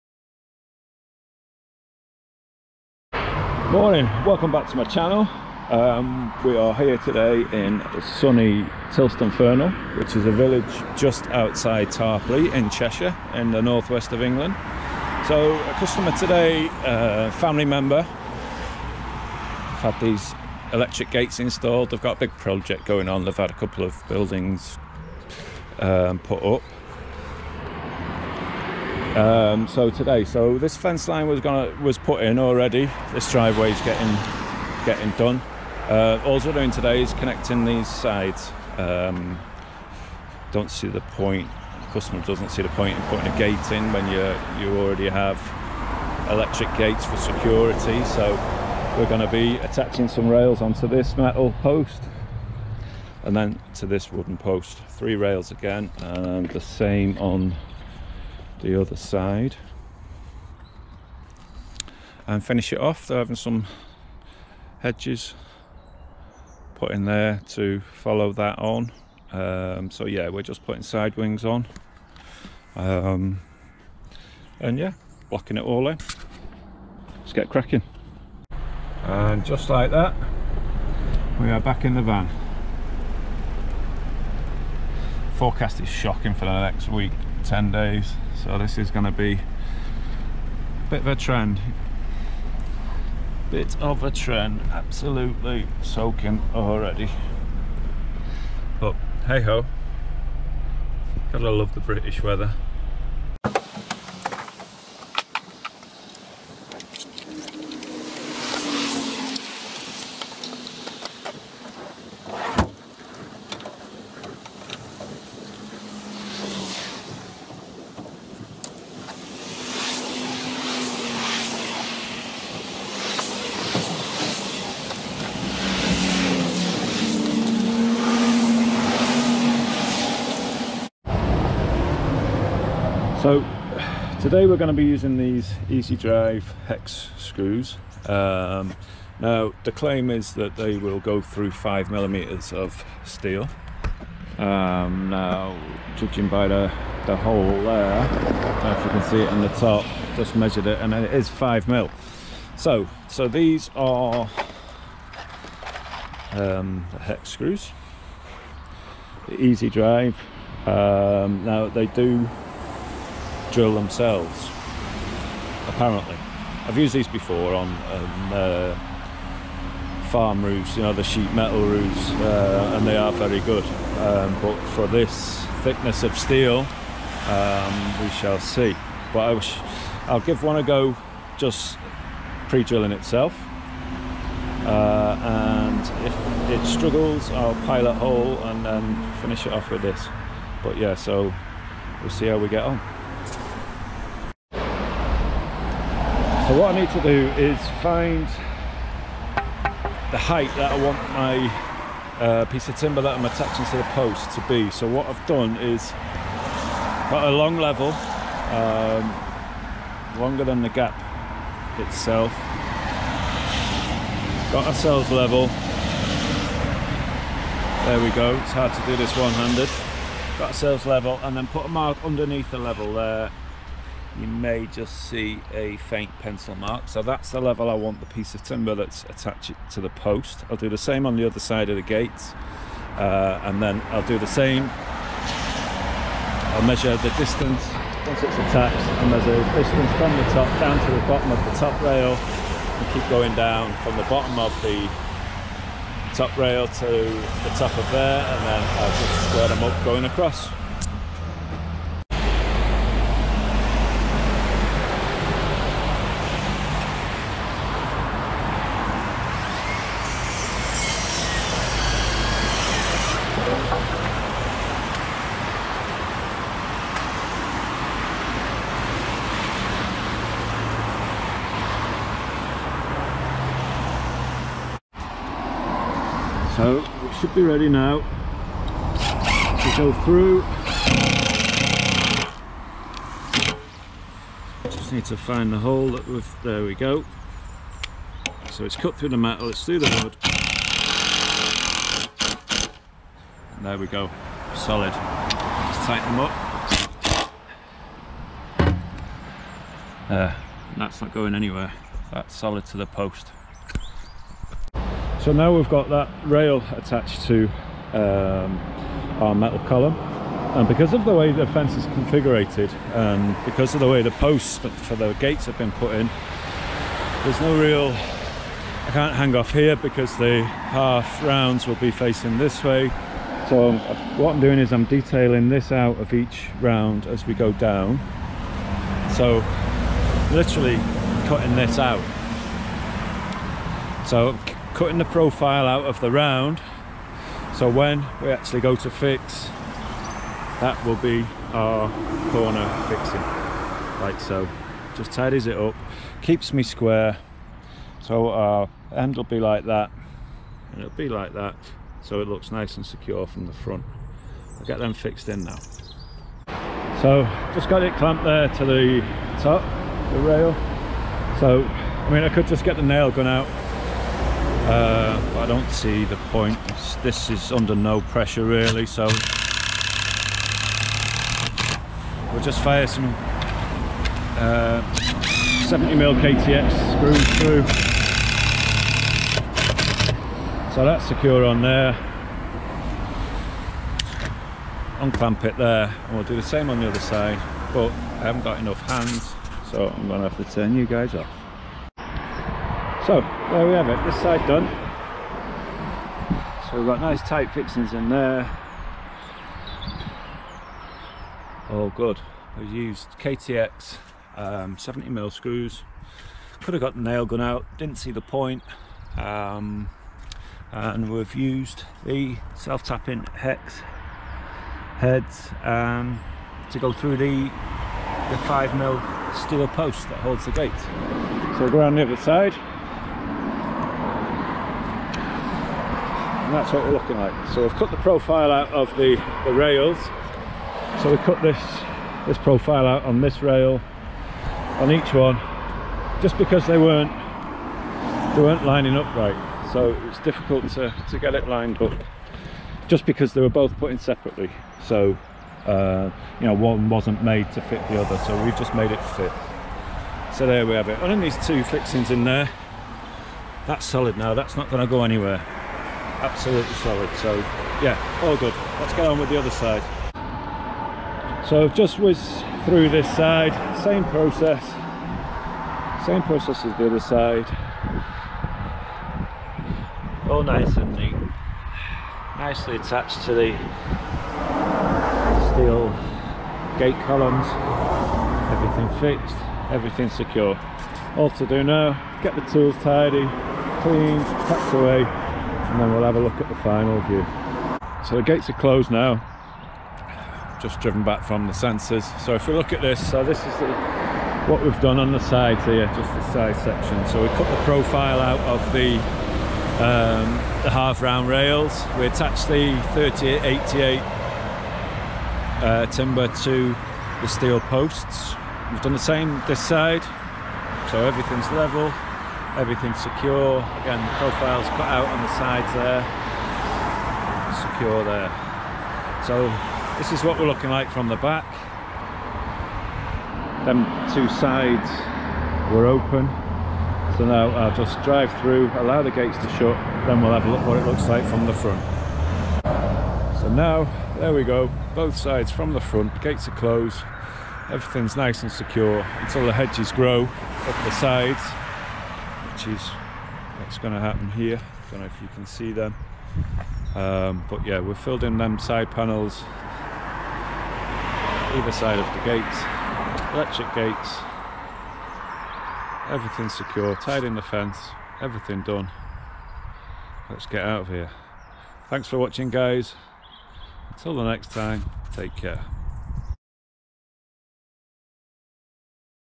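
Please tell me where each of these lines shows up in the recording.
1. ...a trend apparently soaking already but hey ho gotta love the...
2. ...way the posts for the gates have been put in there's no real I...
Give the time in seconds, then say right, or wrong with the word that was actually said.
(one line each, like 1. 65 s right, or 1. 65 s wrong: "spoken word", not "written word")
1. 94 s wrong: "absolutely", not "apparently"
2. 313 s right.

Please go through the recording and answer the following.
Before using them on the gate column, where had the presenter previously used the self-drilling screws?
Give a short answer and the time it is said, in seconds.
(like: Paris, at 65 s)
farm roofs, at 170 s.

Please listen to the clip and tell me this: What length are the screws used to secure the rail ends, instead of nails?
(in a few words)
70mm.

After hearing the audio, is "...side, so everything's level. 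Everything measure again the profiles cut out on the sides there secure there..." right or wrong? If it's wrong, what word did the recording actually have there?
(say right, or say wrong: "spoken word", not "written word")
wrong: "secure", not "measure".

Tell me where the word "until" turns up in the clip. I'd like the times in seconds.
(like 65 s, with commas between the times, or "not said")
539 s, 563 s.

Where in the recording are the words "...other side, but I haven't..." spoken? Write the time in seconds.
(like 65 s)
386 s.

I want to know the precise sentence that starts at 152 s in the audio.
So, so these are um, the hex screws, the Easy Drive.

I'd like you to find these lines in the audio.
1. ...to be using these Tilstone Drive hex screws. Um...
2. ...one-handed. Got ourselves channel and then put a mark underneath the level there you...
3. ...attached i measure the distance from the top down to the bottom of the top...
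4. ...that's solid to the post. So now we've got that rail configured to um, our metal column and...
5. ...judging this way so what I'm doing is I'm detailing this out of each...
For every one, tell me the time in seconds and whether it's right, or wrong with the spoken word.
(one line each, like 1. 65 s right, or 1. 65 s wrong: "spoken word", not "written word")
1. 134 s wrong: "Easy", not "Tilstone"
2. 219 s wrong: "level", not "channel"
3. 238 s right
4. 302 s wrong: "attached", not "configured"
5. 321 s wrong: "facing", not "judging".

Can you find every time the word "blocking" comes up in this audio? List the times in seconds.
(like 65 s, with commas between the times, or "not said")
75 s.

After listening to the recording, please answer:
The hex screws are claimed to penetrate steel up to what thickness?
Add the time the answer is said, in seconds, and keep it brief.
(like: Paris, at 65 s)
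5 millimeters, at 141 s.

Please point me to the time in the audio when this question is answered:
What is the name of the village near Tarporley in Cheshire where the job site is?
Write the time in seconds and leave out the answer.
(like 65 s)
8 s.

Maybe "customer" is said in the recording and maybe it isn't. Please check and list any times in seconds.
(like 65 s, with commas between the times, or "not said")
15 s, 41 s.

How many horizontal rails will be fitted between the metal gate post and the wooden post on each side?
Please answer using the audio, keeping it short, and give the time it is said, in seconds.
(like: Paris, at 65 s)
3, at 54 s.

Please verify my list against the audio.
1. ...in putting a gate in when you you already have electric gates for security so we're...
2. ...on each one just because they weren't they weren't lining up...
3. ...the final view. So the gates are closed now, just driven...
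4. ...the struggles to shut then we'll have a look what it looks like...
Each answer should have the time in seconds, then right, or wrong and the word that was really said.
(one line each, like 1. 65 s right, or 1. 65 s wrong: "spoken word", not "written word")
1. 42 s right
2. 434 s right
3. 486 s right
4. 529 s wrong: "gates", not "struggles".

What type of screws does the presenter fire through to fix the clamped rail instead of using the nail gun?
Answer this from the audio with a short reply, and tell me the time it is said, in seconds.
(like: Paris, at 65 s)
KTX screws, at 376 s.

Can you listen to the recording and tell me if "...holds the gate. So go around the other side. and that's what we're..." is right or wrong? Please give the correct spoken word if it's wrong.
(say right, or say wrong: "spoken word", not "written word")
right.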